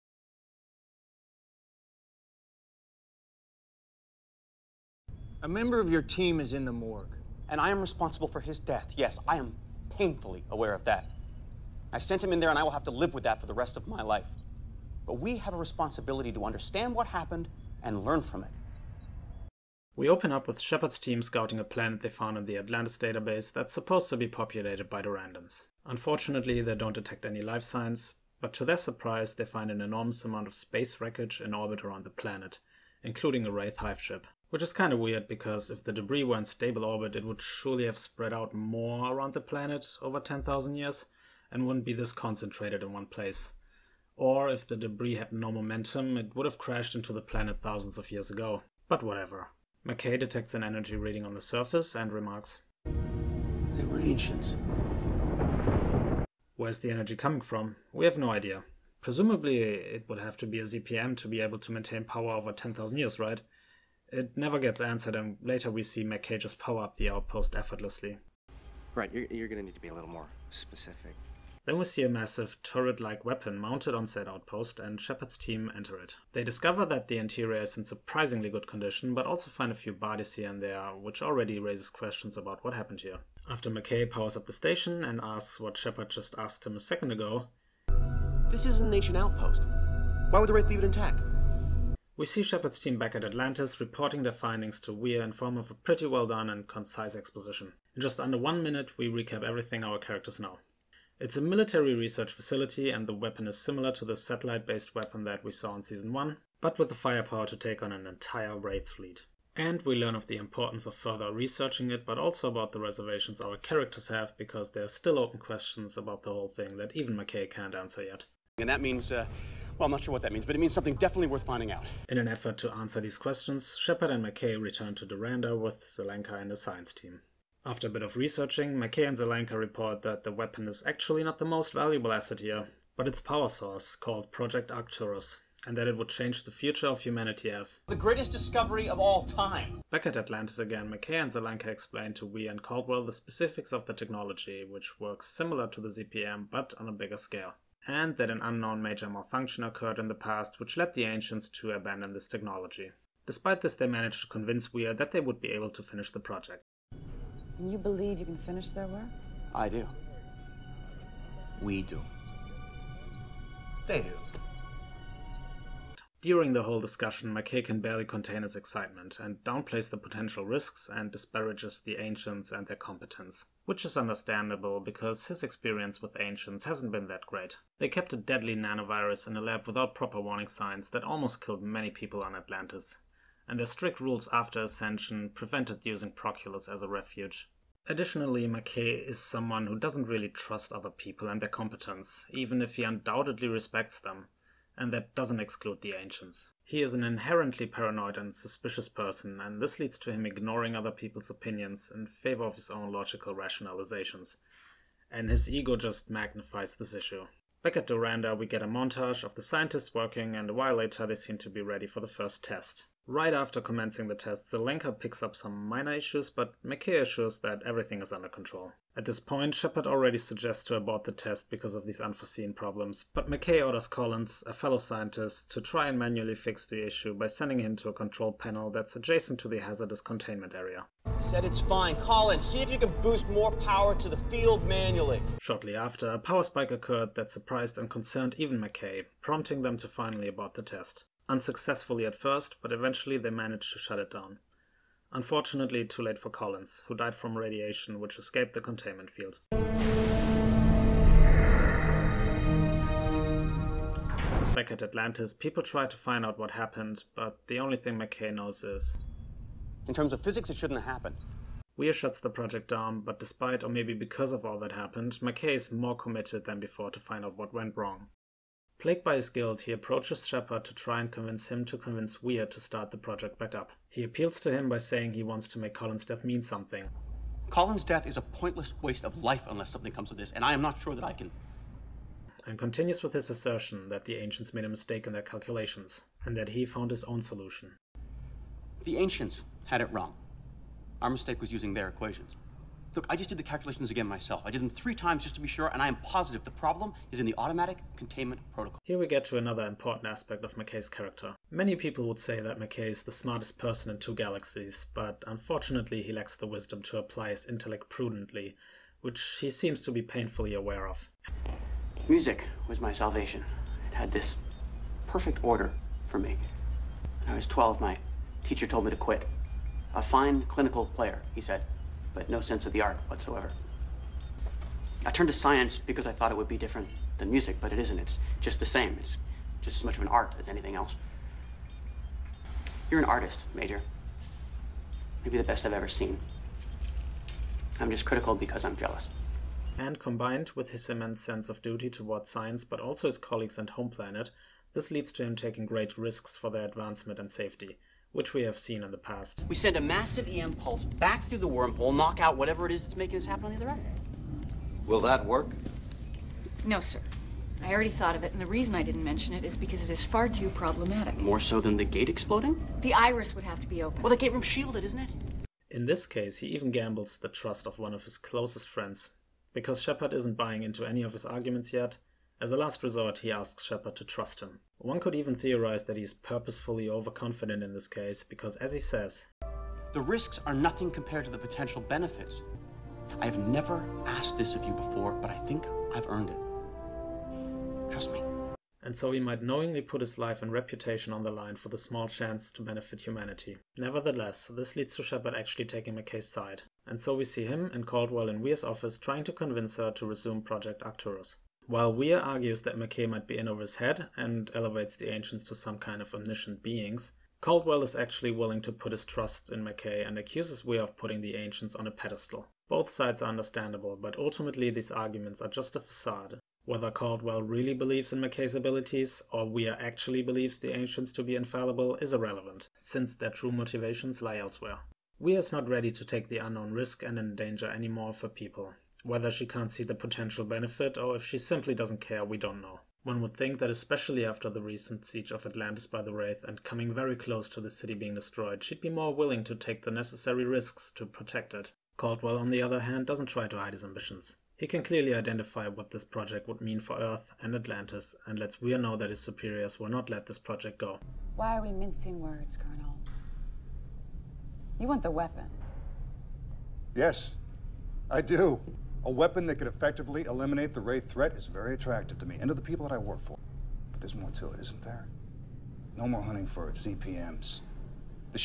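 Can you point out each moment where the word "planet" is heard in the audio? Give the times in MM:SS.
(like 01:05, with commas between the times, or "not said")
00:21, 00:32, 00:39, 00:47, 05:43.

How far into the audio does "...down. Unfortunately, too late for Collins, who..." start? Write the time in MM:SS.
04:04.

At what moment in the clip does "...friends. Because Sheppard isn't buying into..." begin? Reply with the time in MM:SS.
06:08.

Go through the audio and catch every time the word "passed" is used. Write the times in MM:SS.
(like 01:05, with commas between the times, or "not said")
not said.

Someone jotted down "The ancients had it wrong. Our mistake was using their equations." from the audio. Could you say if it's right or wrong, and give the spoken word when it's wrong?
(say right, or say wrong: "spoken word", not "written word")
right.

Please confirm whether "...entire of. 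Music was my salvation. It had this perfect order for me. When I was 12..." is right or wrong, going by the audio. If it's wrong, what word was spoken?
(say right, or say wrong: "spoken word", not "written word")
wrong: "aware", not "entire".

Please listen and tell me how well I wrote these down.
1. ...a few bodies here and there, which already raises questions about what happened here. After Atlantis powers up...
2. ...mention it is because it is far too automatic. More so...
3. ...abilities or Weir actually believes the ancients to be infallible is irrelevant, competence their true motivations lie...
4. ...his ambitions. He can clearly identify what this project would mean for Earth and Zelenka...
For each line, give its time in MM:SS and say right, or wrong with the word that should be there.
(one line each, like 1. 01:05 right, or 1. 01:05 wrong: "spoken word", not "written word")
1. 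01:19 wrong: "McKay", not "Atlantis"
2. 05:59 wrong: "problematic", not "automatic"
3. 06:58 wrong: "since", not "competence"
4. 07:23 wrong: "Atlantis", not "Zelenka".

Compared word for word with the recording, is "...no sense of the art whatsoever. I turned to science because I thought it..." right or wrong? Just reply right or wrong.
right.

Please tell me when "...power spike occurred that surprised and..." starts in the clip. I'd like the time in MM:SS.
03:56.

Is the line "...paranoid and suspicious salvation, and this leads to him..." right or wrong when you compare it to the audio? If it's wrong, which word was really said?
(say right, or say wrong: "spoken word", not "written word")
wrong: "person", not "salvation".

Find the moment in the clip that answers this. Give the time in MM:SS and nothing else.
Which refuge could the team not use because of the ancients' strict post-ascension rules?
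03:06.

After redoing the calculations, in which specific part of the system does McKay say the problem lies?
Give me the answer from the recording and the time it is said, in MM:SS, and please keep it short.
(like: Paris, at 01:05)
Automatic containment protocol, at 04:57.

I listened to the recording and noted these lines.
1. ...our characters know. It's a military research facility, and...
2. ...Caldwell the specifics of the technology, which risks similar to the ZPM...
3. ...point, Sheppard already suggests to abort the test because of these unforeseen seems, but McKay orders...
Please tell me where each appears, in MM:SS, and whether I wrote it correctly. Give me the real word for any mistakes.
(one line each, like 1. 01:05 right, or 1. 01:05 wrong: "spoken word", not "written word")
1. 01:39 right
2. 02:22 wrong: "works", not "risks"
3. 03:39 wrong: "problems", not "seems".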